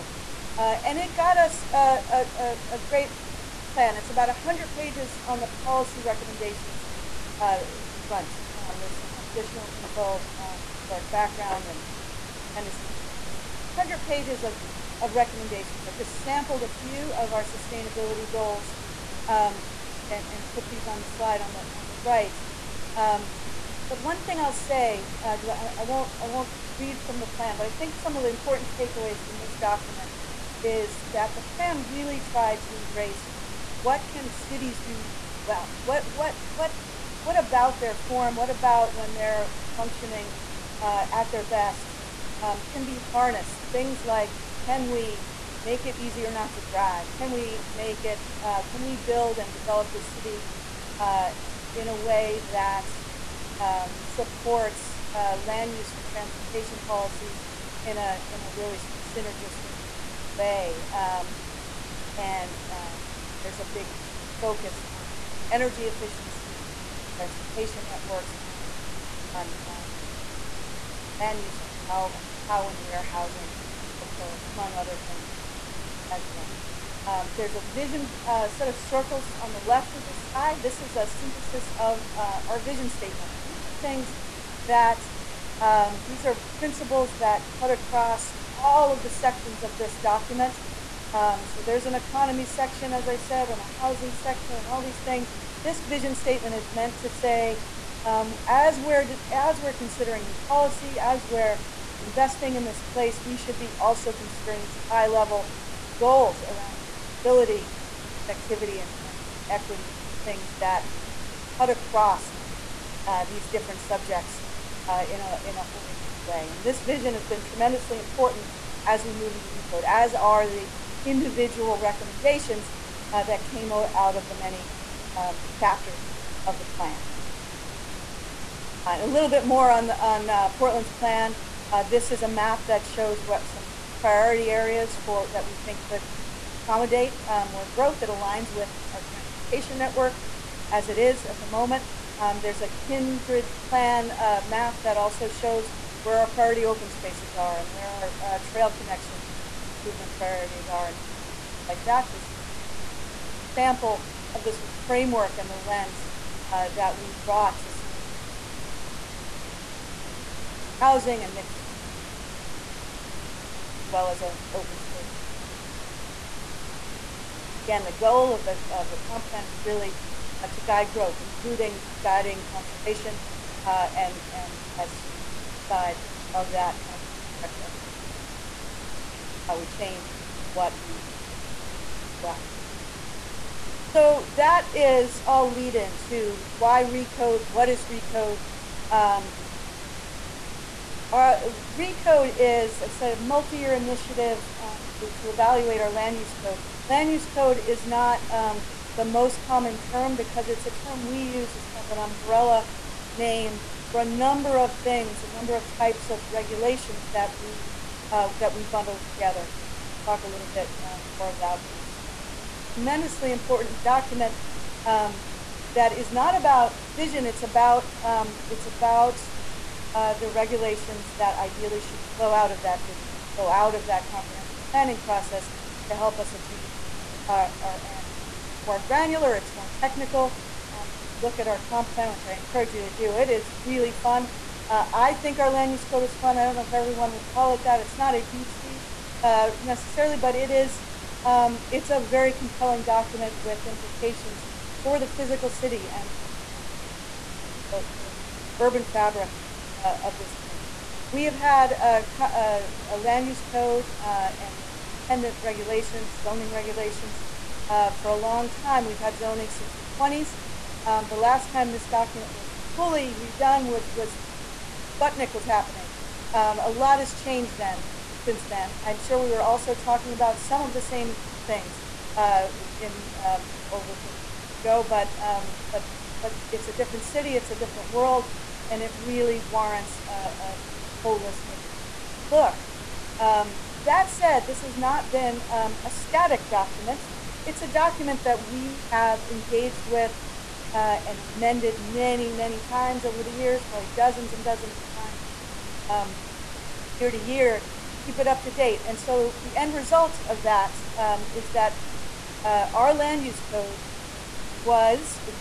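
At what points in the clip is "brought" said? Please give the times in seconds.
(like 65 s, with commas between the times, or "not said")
157 s.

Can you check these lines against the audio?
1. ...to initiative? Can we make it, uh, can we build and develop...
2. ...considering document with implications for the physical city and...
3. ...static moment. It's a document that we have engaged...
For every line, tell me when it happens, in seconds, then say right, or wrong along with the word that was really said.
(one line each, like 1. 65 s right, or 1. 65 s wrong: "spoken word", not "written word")
1. 46 s wrong: "drive", not "initiative"
2. 242 s wrong: "compelling", not "considering"
3. 285 s wrong: "document", not "moment".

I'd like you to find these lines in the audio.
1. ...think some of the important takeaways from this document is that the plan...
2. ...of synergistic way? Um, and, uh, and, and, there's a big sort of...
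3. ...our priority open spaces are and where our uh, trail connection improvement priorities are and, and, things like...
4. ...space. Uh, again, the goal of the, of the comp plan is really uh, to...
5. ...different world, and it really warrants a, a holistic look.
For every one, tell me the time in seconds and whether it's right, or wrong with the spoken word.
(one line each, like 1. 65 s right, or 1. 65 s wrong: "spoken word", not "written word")
1. 27 s right
2. 58 s right
3. 146 s right
4. 164 s right
5. 277 s right.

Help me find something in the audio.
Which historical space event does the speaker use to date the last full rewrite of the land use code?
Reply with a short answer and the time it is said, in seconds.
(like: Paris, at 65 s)
Sputnik, at 265 s.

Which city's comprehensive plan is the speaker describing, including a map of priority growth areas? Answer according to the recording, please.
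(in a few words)
Portland.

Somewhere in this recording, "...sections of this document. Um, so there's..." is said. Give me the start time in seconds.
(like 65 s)
89 s.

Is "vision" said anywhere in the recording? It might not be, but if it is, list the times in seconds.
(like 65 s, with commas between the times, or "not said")
77 s, 82 s, 95 s, 116 s, 216 s, 222 s.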